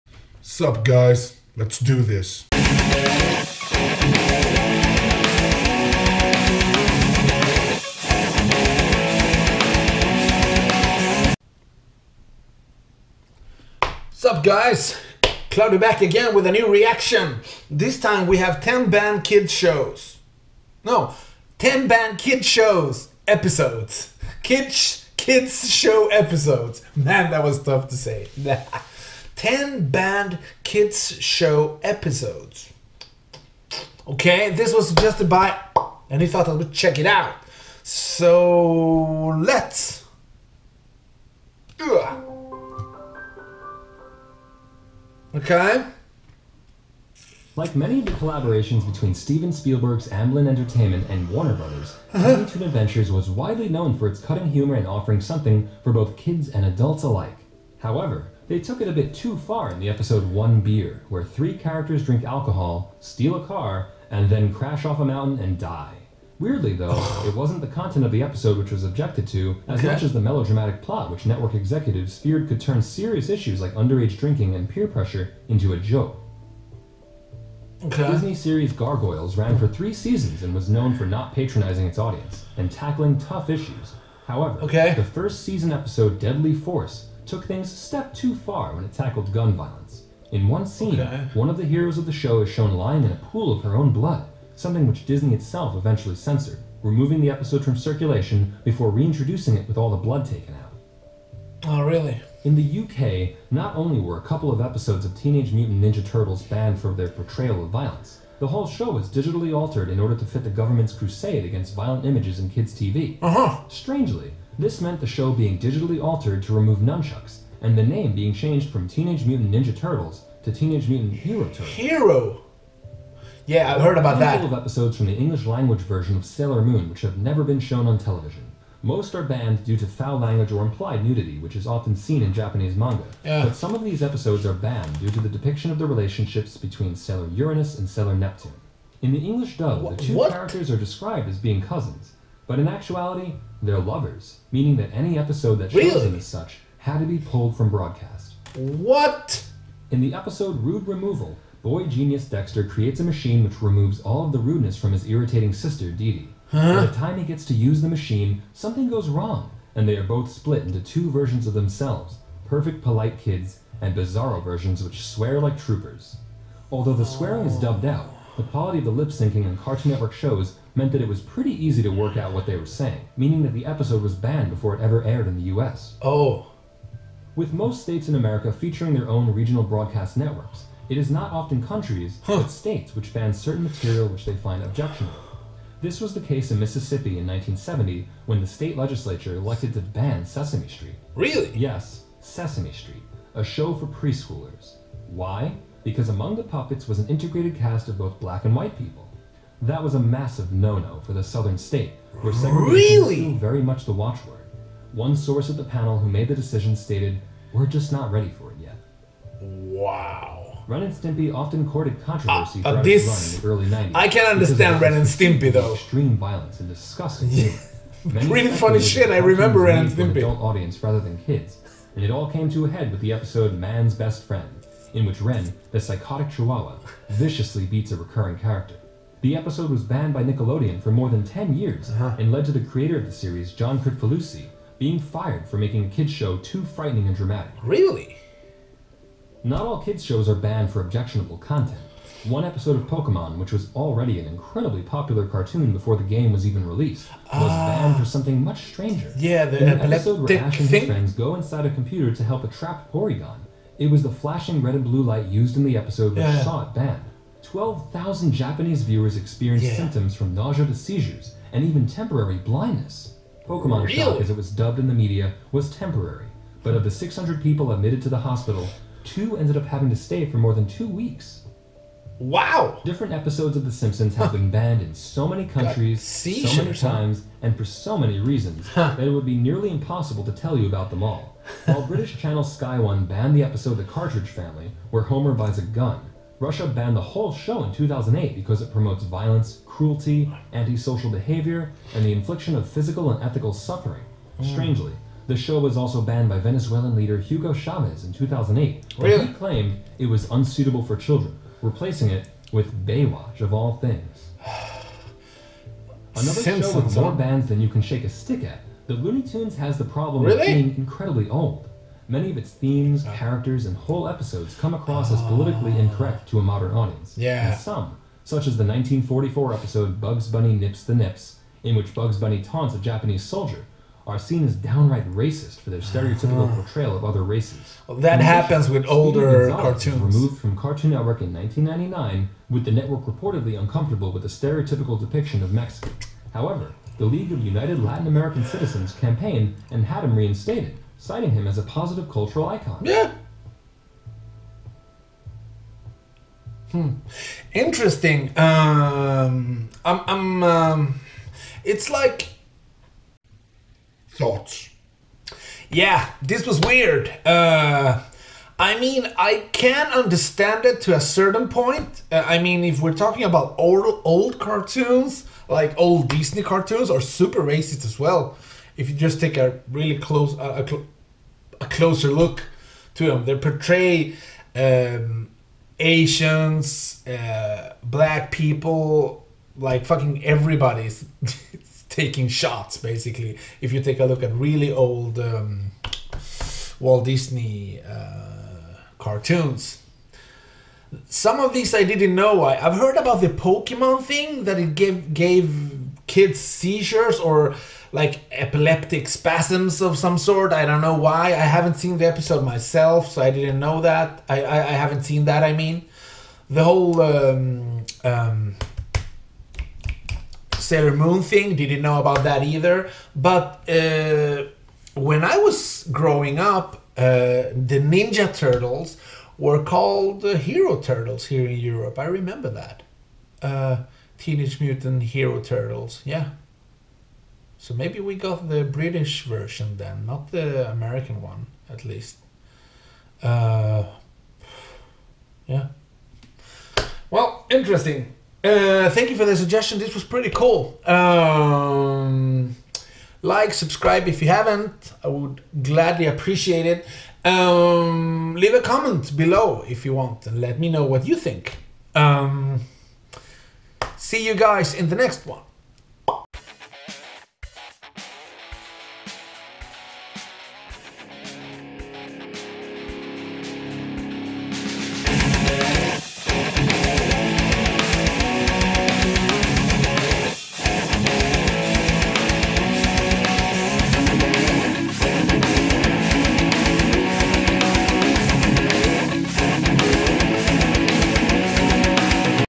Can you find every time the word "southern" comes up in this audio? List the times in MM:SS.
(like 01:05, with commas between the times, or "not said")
03:21.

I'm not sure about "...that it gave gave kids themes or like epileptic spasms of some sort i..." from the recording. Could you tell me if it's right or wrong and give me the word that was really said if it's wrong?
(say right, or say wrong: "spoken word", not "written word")
wrong: "seizures", not "themes".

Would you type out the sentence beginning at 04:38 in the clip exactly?
that it would be nearly impossible to tell you about them all.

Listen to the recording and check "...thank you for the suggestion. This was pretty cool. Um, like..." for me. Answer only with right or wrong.
right.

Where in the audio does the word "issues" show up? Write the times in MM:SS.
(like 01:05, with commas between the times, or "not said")
01:13, 01:23.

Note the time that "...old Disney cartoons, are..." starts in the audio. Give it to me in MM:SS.
06:05.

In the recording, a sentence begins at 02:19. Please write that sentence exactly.
In the English dub, Wh- the two what?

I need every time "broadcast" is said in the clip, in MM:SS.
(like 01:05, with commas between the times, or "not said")
02:27, 02:59.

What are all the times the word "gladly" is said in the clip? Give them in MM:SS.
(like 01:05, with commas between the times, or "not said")
07:25.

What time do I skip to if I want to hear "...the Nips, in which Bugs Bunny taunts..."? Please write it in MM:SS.
05:20.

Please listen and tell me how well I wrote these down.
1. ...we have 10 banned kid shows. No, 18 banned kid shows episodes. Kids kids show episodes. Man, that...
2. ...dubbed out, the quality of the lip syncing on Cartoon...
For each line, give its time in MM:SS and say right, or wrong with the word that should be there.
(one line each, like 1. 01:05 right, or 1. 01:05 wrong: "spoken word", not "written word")
1. 00:18 wrong: "10", not "18"
2. 02:47 right.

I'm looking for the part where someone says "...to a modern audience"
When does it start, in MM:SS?
05:16.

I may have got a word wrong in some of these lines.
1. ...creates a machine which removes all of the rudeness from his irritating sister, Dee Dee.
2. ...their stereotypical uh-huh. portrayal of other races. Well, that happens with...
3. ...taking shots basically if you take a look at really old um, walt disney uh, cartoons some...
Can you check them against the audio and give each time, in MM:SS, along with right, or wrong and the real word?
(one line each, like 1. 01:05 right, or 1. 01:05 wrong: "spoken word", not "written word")
1. 02:32 right
2. 05:25 right
3. 06:21 right.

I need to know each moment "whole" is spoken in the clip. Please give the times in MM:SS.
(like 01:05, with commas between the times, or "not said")
01:48, 04:47, 05:13, 06:46.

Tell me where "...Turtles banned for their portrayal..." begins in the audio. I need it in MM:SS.
01:46.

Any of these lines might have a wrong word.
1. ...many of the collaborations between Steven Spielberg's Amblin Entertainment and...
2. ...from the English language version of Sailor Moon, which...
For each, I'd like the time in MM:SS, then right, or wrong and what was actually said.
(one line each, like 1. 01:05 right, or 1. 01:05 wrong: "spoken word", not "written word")
1. 00:47 right
2. 02:04 right.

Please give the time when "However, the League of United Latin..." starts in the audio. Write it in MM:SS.
05:36.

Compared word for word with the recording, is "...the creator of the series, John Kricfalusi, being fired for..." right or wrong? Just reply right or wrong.
right.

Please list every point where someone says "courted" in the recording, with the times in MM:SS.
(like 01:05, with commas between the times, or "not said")
03:31.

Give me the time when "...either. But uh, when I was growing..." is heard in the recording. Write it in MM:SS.
06:52.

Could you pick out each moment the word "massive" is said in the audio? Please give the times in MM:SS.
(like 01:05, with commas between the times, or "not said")
03:19.